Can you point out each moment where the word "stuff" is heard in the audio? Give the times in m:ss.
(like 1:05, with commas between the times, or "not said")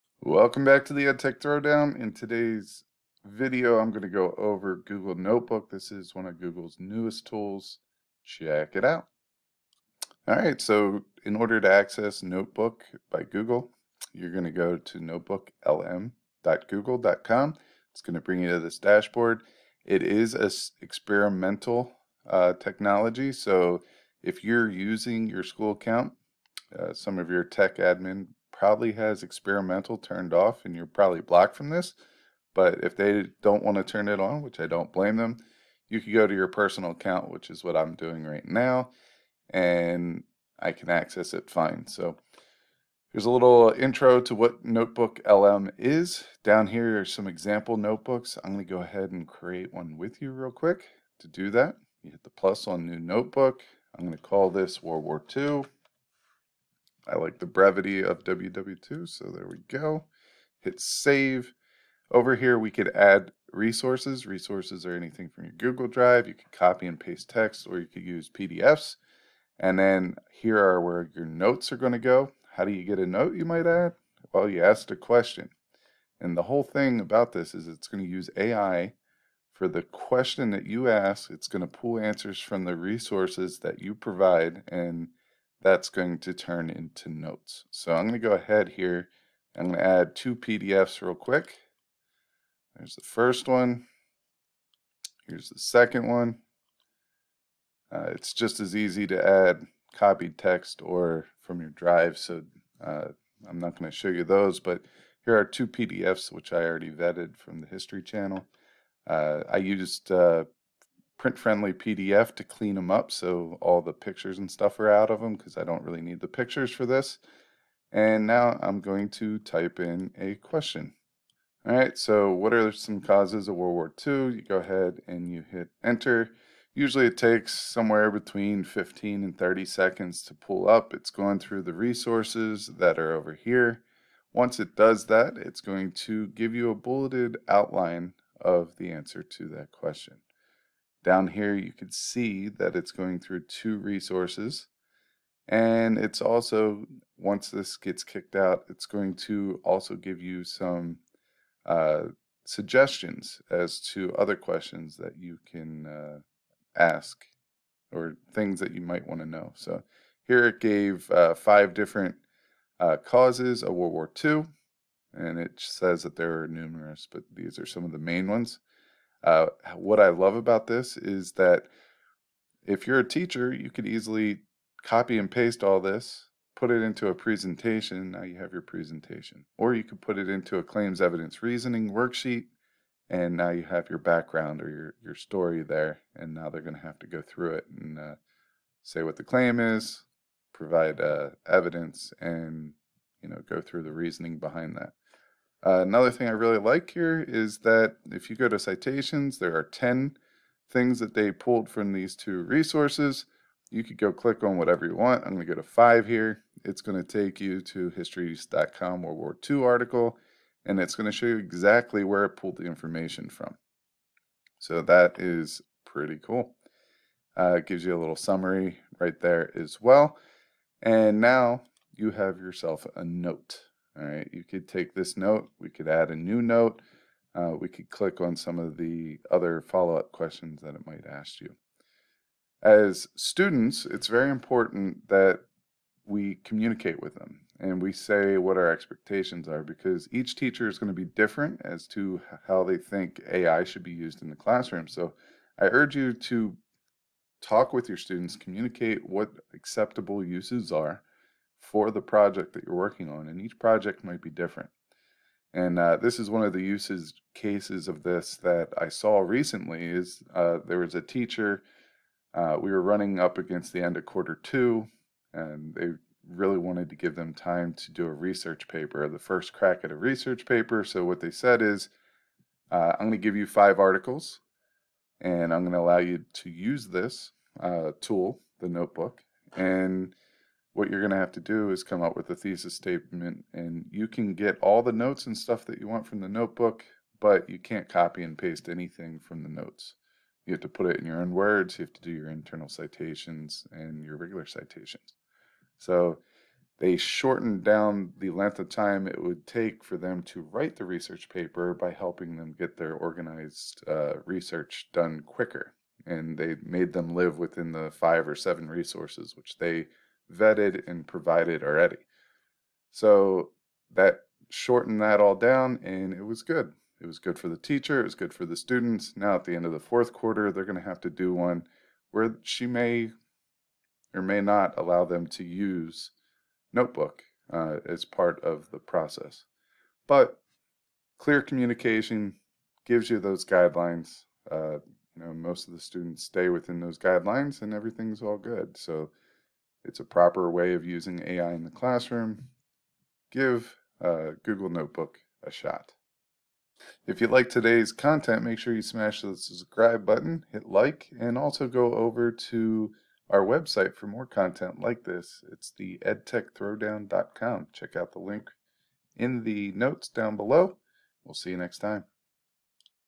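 1:54, 4:45.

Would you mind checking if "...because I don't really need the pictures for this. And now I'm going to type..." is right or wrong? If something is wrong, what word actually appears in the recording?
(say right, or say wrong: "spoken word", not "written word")
right.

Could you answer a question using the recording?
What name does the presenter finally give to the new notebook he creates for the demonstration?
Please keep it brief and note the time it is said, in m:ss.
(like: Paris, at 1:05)
WW2, at 0:58.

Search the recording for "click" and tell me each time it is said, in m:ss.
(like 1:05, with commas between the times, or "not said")
3:24, 3:47.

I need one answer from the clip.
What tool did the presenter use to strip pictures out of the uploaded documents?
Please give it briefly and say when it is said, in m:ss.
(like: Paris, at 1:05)
print friendly PDF, at 1:51.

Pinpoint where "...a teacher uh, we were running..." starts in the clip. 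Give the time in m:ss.
4:20.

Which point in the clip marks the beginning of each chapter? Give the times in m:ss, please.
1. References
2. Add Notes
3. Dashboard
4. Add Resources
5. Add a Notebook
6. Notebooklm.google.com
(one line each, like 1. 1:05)
1. 3:23
2. 1:15
3. 0:40
4. 1:35
5. 0:55
6. 0:10.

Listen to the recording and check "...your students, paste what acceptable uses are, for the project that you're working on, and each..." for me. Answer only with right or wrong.
wrong.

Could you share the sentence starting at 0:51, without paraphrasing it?
To do that, you hit the plus on new notebook.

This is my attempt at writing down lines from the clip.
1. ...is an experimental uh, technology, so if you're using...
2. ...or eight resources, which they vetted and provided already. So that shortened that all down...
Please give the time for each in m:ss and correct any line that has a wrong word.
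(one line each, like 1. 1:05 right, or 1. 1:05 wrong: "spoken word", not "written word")
1. 0:20 right
2. 5:08 wrong: "seven", not "eight".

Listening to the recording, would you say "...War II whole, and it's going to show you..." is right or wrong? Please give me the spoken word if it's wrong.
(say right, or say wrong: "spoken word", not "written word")
wrong: "article", not "whole".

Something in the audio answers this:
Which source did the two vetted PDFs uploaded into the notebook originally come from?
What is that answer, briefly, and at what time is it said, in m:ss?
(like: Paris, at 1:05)
History Channel, at 1:47.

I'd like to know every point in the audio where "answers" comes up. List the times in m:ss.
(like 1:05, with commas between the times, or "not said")
1:21, 2:18.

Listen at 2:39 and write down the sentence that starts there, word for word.
So here it gave uh, five different uh, causes of World War II.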